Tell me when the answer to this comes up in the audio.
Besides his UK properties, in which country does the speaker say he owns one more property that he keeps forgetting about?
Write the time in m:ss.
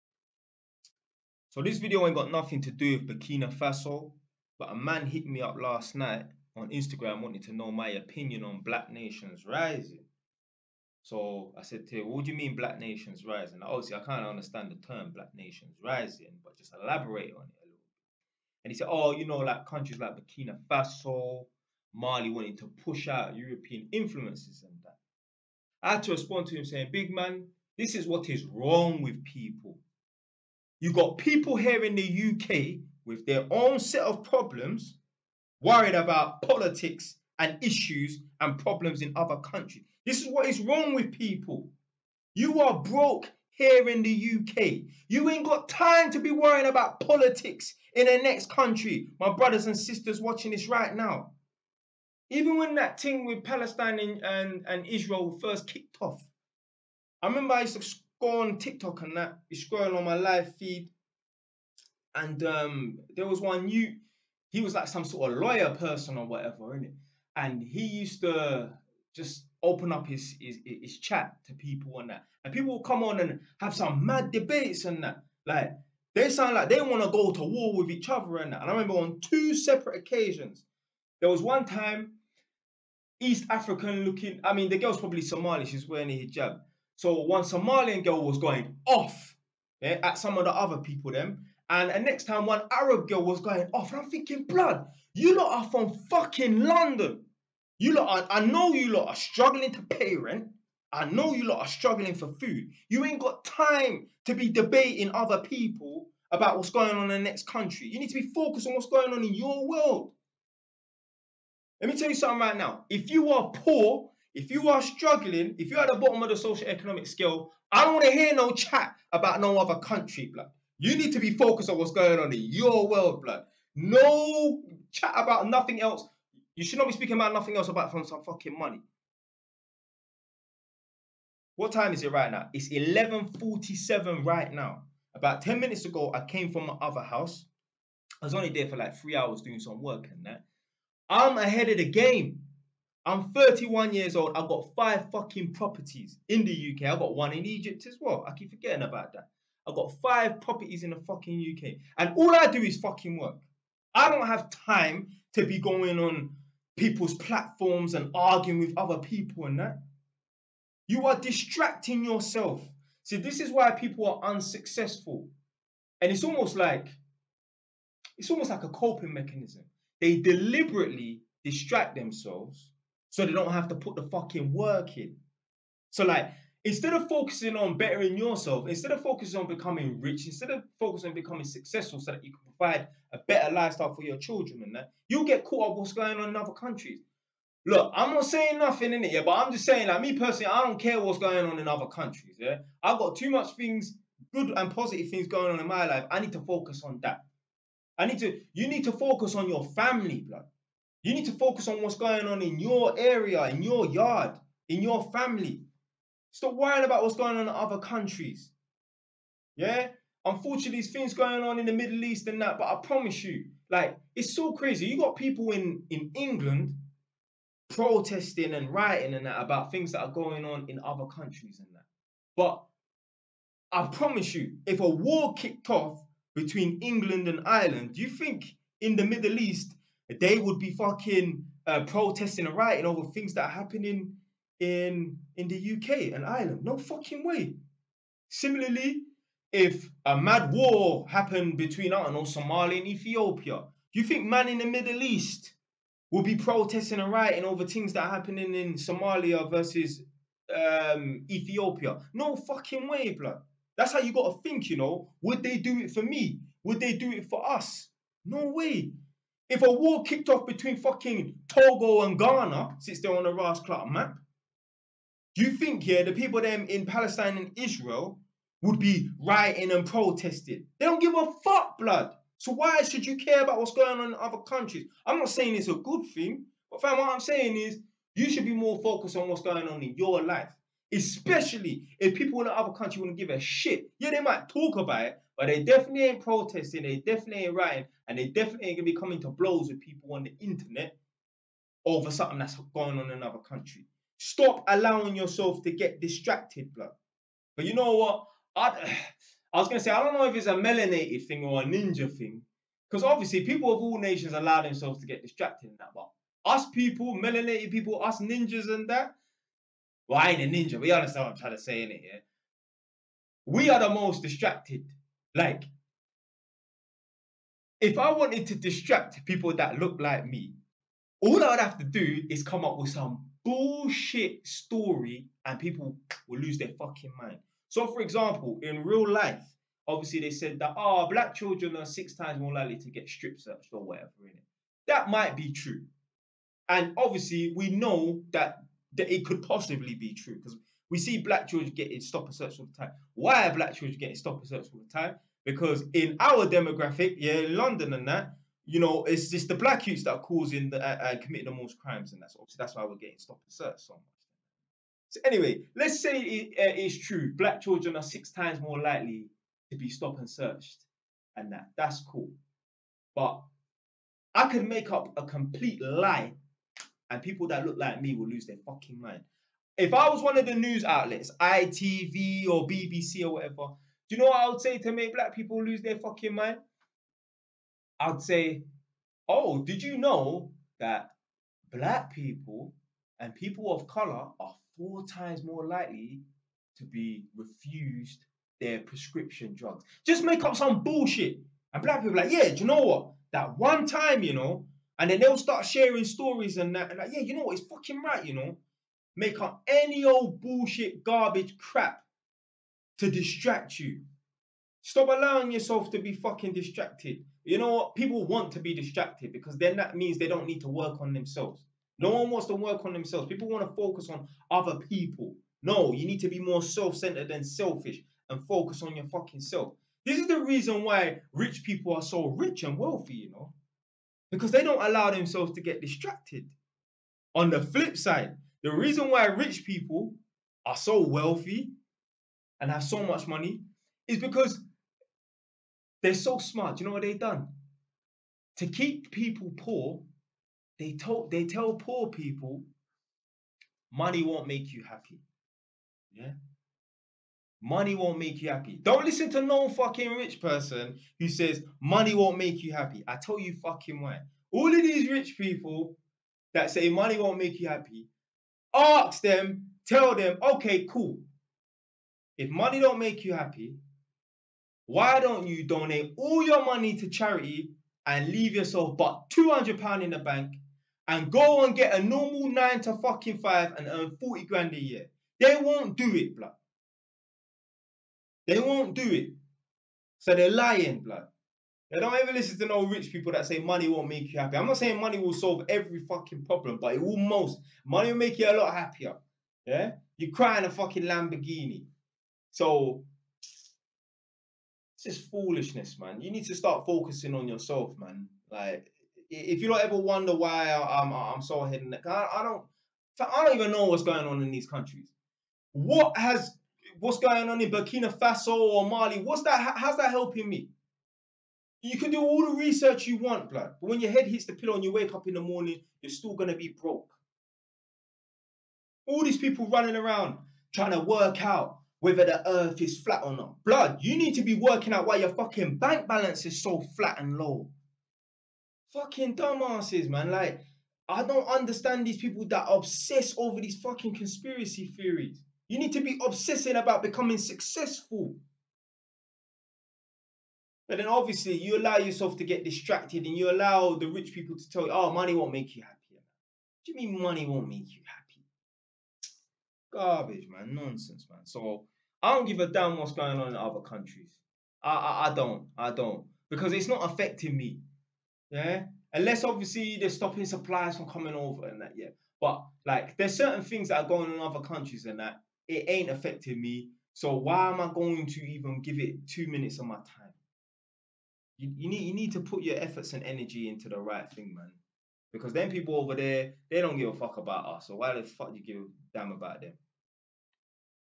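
2:27.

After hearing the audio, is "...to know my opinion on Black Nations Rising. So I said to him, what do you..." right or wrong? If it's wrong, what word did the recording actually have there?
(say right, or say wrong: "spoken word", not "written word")
right.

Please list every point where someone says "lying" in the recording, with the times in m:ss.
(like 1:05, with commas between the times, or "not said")
8:00.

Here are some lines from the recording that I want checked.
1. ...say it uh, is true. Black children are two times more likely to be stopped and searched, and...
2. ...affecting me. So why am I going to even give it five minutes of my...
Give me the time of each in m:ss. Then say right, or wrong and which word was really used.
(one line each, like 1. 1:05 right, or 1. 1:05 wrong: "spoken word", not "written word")
1. 5:56 wrong: "six", not "two"
2. 9:26 wrong: "two", not "five".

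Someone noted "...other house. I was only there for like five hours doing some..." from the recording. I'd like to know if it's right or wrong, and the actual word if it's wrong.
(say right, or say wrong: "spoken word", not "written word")
wrong: "three", not "five".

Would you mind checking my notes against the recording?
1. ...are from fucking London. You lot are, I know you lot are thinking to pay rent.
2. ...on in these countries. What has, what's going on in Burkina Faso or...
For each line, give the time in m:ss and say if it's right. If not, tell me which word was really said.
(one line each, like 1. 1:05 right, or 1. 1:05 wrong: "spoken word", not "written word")
1. 1:35 wrong: "struggling", not "thinking"
2. 8:24 right.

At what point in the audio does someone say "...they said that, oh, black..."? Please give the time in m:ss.
5:30.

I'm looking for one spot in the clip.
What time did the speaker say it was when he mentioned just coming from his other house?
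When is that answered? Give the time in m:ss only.
2:12.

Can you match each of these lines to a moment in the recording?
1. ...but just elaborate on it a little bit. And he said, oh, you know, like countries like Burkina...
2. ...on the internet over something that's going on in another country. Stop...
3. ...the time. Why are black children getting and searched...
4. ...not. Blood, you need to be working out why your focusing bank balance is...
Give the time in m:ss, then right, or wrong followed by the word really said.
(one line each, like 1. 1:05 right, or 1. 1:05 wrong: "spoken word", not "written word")
1. 0:16 right
2. 4:50 right
3. 5:42 right
4. 8:43 wrong: "fucking", not "focusing".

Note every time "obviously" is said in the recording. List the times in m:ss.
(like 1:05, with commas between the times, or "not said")
0:13, 5:03, 5:29, 5:36, 5:52, 9:01, 9:19.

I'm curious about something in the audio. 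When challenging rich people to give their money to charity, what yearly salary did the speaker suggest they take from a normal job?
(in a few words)
40 grand.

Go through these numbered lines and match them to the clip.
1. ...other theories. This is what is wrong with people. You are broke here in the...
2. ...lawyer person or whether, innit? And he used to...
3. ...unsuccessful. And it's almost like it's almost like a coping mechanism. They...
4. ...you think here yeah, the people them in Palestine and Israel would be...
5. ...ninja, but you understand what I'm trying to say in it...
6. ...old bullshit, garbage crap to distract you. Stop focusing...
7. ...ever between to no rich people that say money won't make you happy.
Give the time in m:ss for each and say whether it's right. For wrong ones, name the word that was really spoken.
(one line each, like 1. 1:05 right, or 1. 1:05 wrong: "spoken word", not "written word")
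1. 0:39 wrong: "countries", not "theories"
2. 1:05 wrong: "whatever", not "whether"
3. 2:44 right
4. 4:25 right
5. 5:10 right
6. 6:40 wrong: "allowing", not "focusing"
7. 8:02 wrong: "listen", not "between".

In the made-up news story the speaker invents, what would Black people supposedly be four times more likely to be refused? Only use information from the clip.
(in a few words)
Prescription drugs.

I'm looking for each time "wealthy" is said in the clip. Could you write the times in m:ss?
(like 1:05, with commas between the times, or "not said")
7:02, 7:11.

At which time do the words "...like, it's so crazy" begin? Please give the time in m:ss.
3:33.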